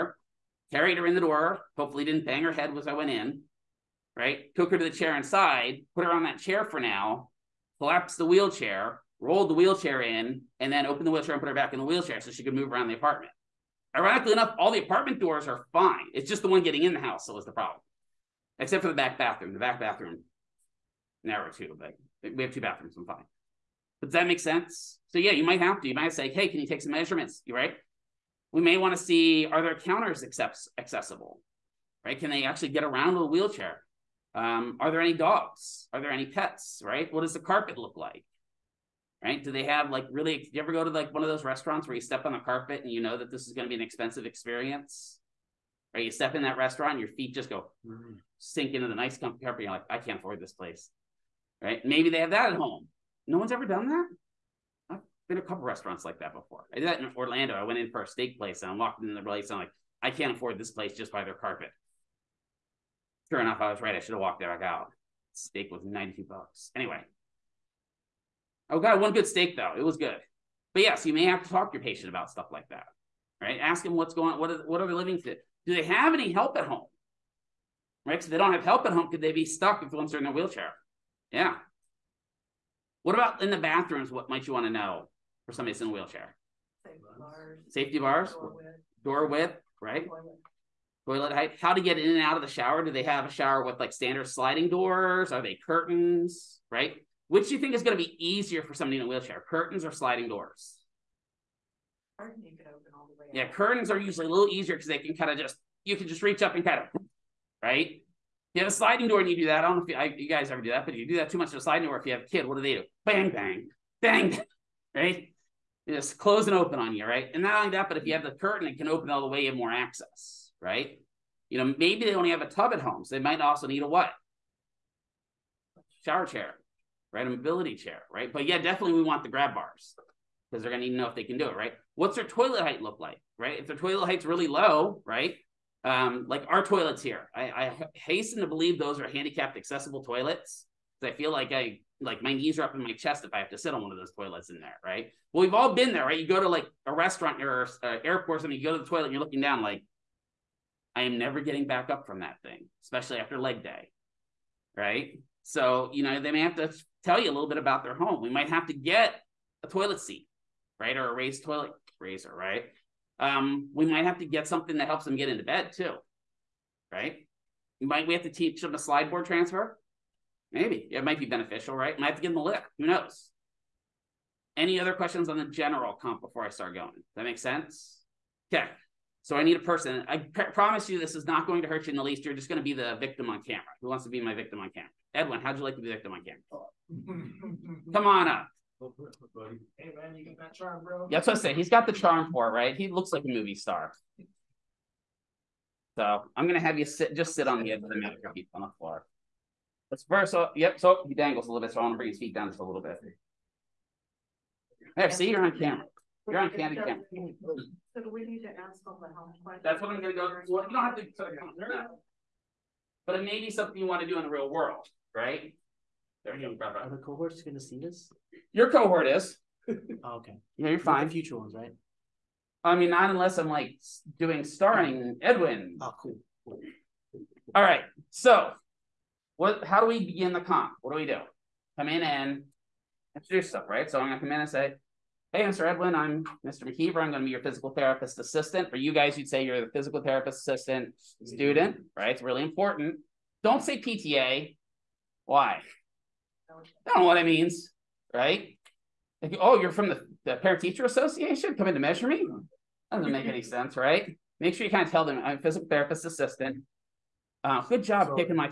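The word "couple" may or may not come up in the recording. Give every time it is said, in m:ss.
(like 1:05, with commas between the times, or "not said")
0:55.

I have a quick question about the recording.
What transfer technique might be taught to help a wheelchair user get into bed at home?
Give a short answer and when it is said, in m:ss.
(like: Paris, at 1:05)
slide board transfer, at 2:48.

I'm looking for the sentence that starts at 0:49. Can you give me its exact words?
You're like, I can't afford this place, right?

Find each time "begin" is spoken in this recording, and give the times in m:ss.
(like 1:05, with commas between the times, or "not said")
3:49.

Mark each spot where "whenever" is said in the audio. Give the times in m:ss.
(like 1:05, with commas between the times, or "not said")
not said.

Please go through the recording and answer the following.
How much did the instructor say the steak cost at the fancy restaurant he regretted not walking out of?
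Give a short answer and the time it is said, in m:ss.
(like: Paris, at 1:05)
$92, at 1:05.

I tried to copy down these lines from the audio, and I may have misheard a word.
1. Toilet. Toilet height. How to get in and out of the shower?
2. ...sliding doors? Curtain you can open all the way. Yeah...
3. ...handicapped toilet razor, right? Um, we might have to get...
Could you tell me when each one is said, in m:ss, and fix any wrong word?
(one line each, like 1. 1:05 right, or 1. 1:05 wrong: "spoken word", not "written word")
1. 1:30 right
2. 1:39 right
3. 2:41 wrong: "raised", not "handicapped".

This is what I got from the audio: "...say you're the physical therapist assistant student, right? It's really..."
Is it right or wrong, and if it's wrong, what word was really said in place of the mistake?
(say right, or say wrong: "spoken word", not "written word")
right.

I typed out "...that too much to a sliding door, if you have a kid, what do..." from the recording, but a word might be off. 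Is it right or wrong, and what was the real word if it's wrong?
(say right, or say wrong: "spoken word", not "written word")
right.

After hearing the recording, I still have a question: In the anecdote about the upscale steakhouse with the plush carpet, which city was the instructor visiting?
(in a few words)
Orlando.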